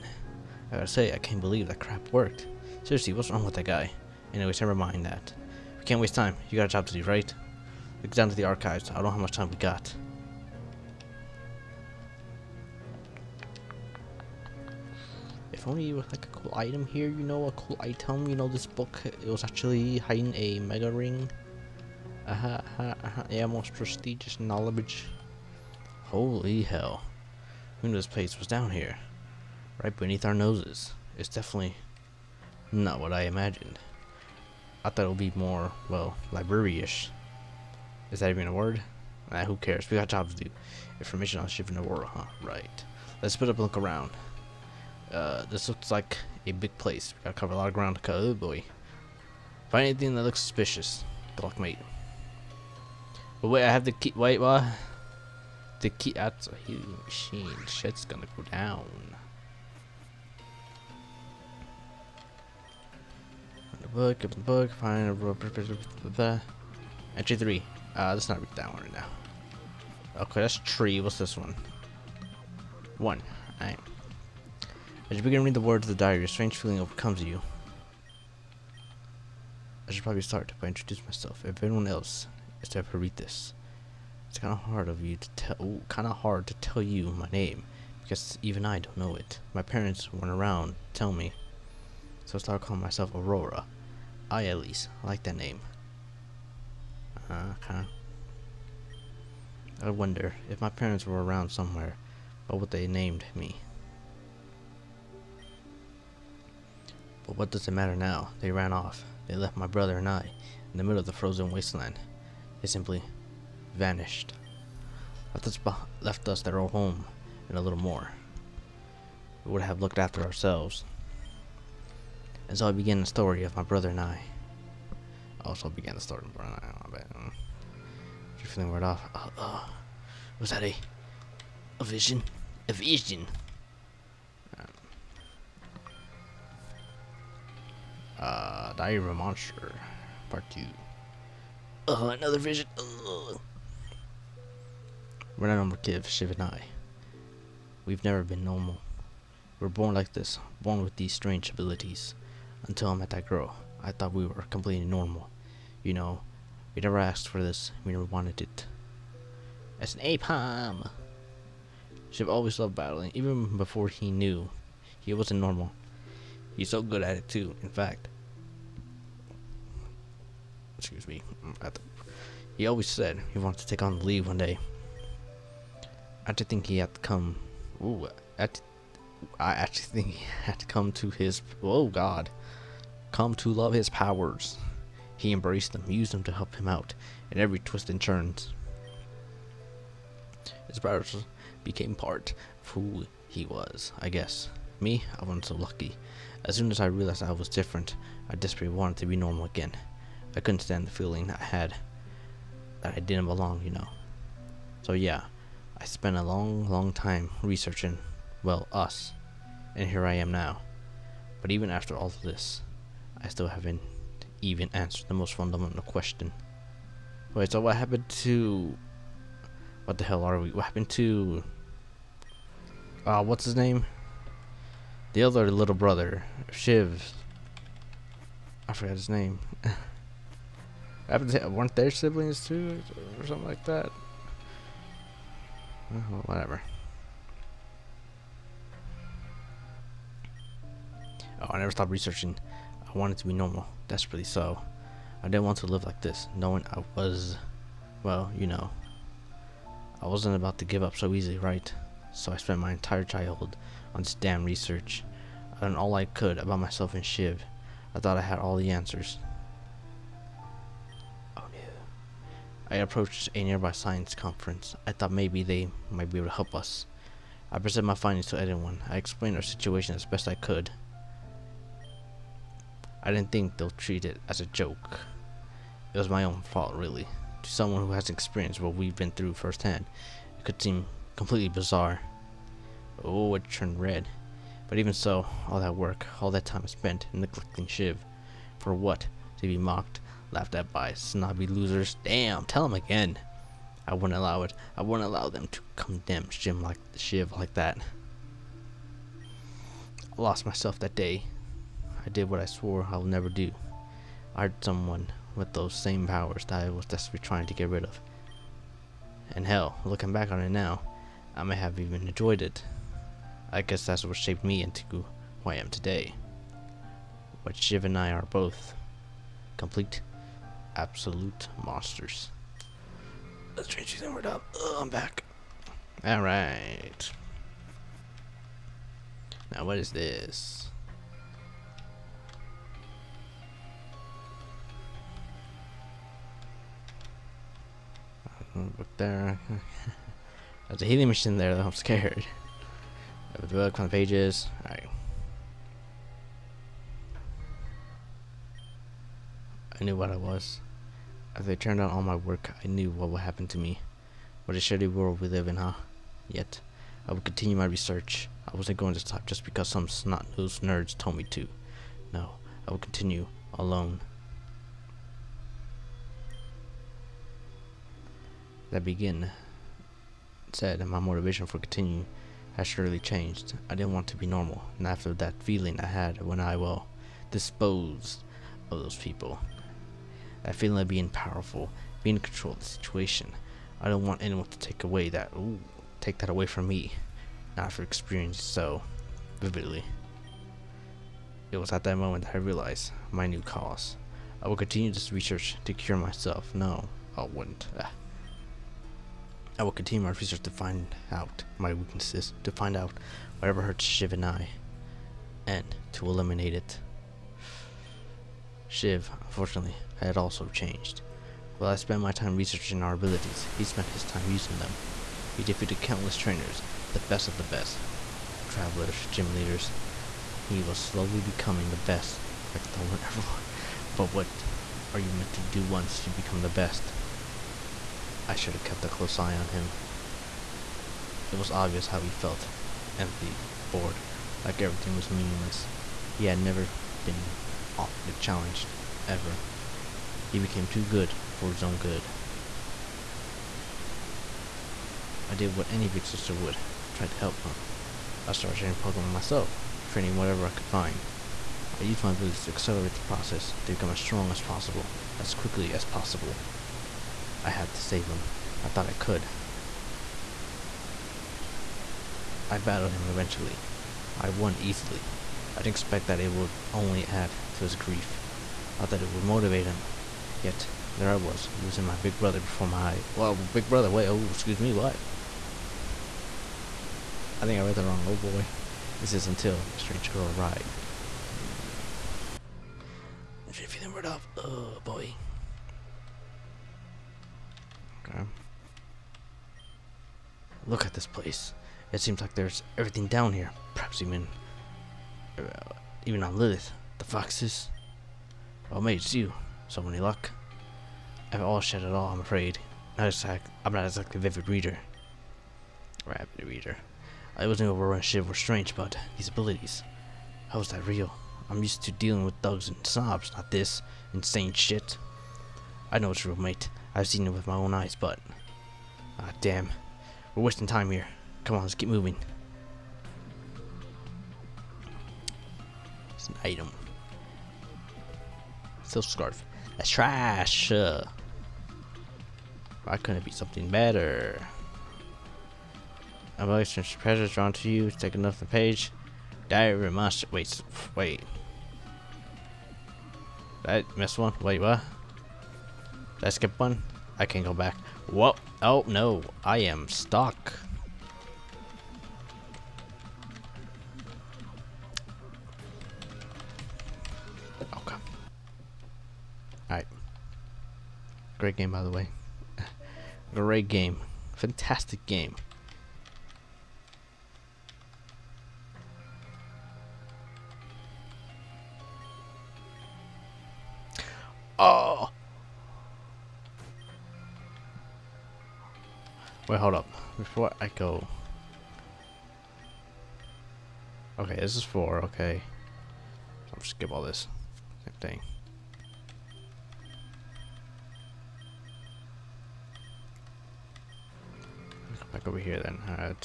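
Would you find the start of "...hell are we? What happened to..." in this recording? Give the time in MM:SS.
03:40.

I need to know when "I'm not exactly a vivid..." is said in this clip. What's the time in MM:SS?
08:23.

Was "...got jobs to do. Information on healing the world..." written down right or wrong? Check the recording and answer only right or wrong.
wrong.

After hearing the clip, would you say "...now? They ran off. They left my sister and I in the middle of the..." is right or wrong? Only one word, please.
wrong.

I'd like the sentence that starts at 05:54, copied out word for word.
What a shitty world we live in, huh?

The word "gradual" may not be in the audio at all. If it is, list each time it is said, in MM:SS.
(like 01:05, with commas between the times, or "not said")
not said.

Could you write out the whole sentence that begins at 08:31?
I'm used to dealing with thugs and sobs, not this insane shit.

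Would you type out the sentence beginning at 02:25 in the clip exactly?
We're not normal kid, Shiv and I.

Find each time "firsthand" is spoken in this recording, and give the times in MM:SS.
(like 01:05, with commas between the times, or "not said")
04:39.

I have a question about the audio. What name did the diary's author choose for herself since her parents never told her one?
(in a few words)
Aurora.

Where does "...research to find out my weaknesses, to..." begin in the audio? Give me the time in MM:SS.
06:40.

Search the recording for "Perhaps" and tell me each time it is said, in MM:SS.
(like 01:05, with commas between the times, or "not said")
08:13.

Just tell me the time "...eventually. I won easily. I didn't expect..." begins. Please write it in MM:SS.
07:43.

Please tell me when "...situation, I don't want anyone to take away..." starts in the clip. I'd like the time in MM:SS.
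06:22.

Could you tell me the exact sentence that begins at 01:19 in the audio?
I should probably start by introducing myself.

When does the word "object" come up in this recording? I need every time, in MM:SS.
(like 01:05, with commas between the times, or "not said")
not said.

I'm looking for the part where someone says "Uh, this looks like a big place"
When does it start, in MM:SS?
00:45.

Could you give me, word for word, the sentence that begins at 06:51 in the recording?
While I spent my time researching our abilities, he spent his time using them.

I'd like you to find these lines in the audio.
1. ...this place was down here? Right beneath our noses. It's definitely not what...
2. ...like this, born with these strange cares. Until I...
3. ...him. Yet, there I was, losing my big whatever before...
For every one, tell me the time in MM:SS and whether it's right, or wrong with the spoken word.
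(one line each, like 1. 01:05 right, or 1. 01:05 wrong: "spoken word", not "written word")
1. 00:27 right
2. 02:29 wrong: "abilities", not "cares"
3. 07:49 wrong: "brother", not "whatever".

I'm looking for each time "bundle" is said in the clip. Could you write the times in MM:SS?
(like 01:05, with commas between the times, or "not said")
not said.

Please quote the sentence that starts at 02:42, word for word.
Shiv always loved battling, even before he knew he wasn't normal.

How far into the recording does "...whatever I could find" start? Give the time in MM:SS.
07:30.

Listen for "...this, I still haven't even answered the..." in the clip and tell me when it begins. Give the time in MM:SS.
03:32.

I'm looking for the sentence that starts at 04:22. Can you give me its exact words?
I approached a nearby science conference.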